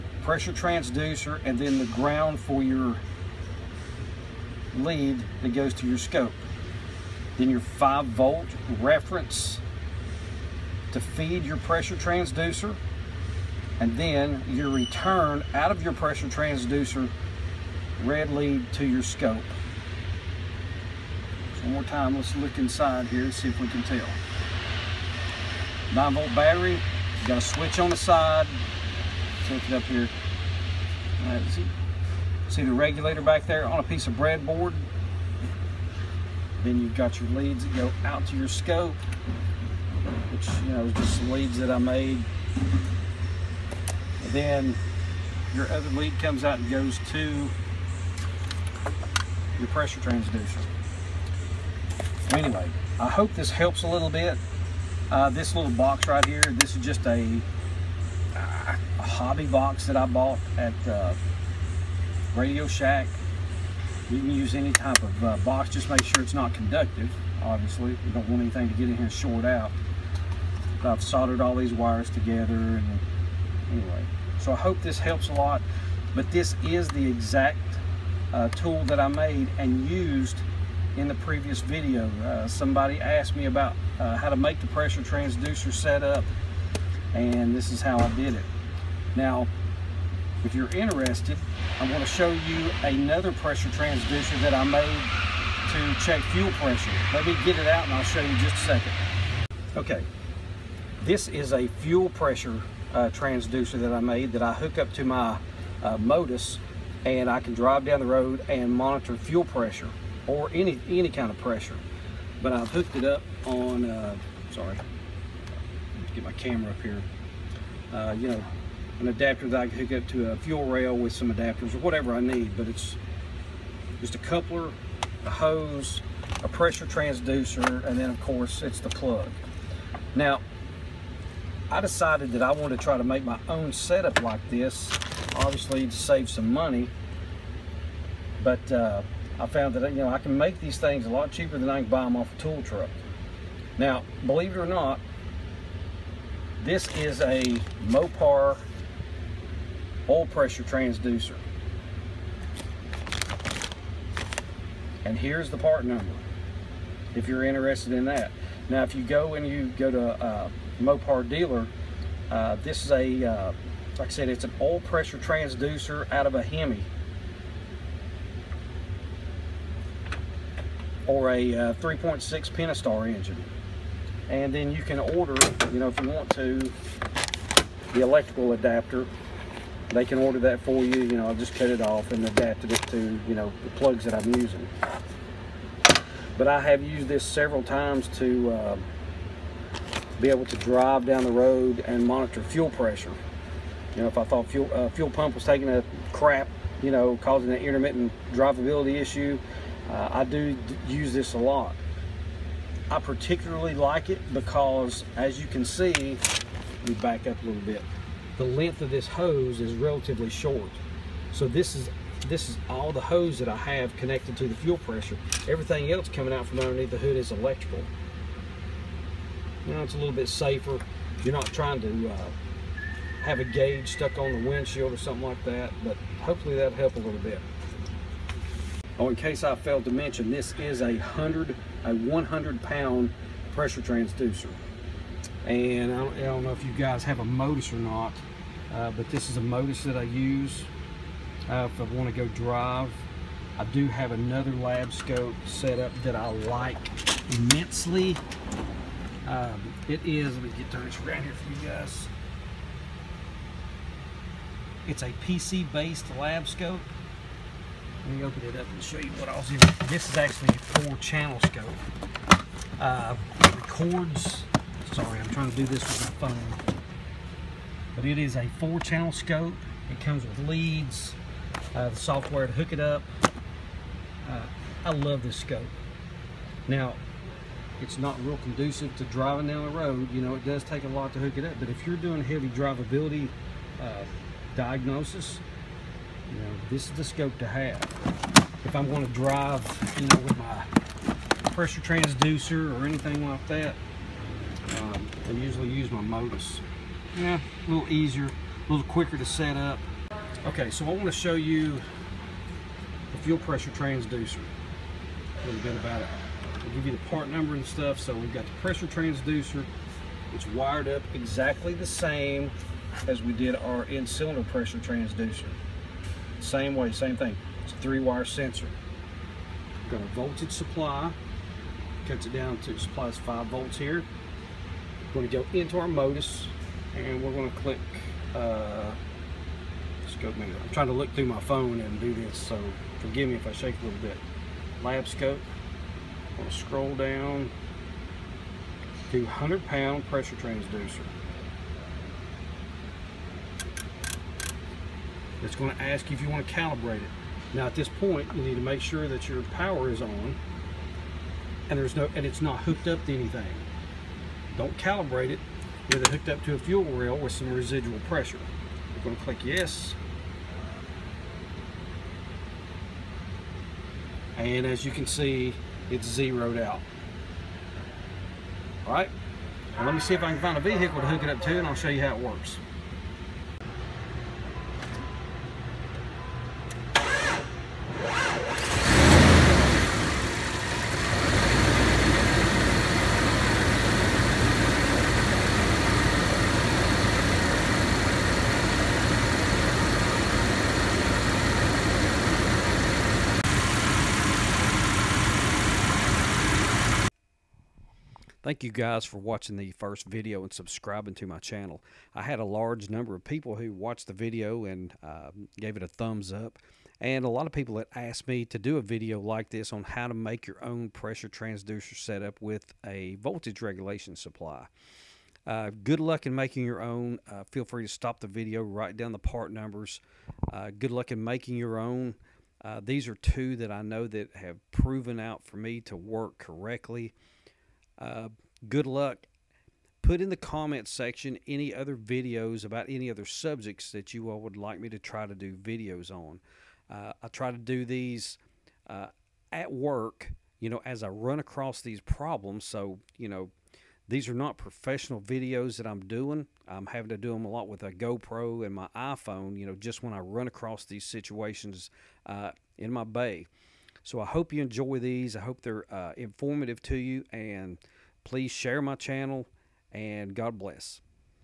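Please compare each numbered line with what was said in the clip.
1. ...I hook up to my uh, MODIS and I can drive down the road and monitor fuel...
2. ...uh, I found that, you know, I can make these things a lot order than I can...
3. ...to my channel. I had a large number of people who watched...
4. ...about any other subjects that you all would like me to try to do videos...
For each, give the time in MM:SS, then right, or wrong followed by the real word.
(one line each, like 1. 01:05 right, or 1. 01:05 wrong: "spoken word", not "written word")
1. 01:44 right
2. 02:18 wrong: "cheaper", not "order"
3. 06:41 right
4. 07:12 right.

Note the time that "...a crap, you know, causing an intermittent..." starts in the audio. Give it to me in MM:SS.
03:15.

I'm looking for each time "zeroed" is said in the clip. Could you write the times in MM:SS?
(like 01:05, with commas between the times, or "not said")
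06:06.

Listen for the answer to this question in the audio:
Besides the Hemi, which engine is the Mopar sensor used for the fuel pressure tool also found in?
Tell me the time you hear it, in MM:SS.
02:51.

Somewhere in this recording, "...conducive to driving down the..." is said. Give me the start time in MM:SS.
04:38.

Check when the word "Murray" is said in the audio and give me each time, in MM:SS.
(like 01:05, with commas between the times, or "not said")
not said.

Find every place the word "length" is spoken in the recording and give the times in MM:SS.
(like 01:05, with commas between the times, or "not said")
03:28.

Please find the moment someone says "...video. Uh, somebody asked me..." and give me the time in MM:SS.
01:21.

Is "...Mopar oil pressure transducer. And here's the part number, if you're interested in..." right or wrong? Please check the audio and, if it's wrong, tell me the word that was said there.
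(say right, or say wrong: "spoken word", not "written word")
right.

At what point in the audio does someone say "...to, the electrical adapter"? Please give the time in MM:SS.
02:56.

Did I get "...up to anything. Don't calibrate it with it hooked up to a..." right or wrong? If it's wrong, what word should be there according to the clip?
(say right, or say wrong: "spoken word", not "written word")
right.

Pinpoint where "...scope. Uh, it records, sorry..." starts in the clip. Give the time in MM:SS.
04:21.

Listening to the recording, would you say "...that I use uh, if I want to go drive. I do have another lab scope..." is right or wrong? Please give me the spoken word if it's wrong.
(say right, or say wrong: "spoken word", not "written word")
right.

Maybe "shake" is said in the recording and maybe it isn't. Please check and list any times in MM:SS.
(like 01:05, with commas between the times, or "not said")
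05:33.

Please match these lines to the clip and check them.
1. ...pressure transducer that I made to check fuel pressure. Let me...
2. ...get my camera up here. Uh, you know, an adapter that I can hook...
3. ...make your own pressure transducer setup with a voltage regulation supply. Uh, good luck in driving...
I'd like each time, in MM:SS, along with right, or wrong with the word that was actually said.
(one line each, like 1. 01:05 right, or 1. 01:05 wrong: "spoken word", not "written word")
1. 01:33 right
2. 01:56 right
3. 06:50 wrong: "making", not "driving".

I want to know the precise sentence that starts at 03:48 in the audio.
Oh, in case I failed to mention, this is a 100, a 100 pound pressure transducer.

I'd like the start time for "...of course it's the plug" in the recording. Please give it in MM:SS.
02:08.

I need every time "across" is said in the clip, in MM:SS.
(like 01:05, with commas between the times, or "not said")
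07:21, 07:30.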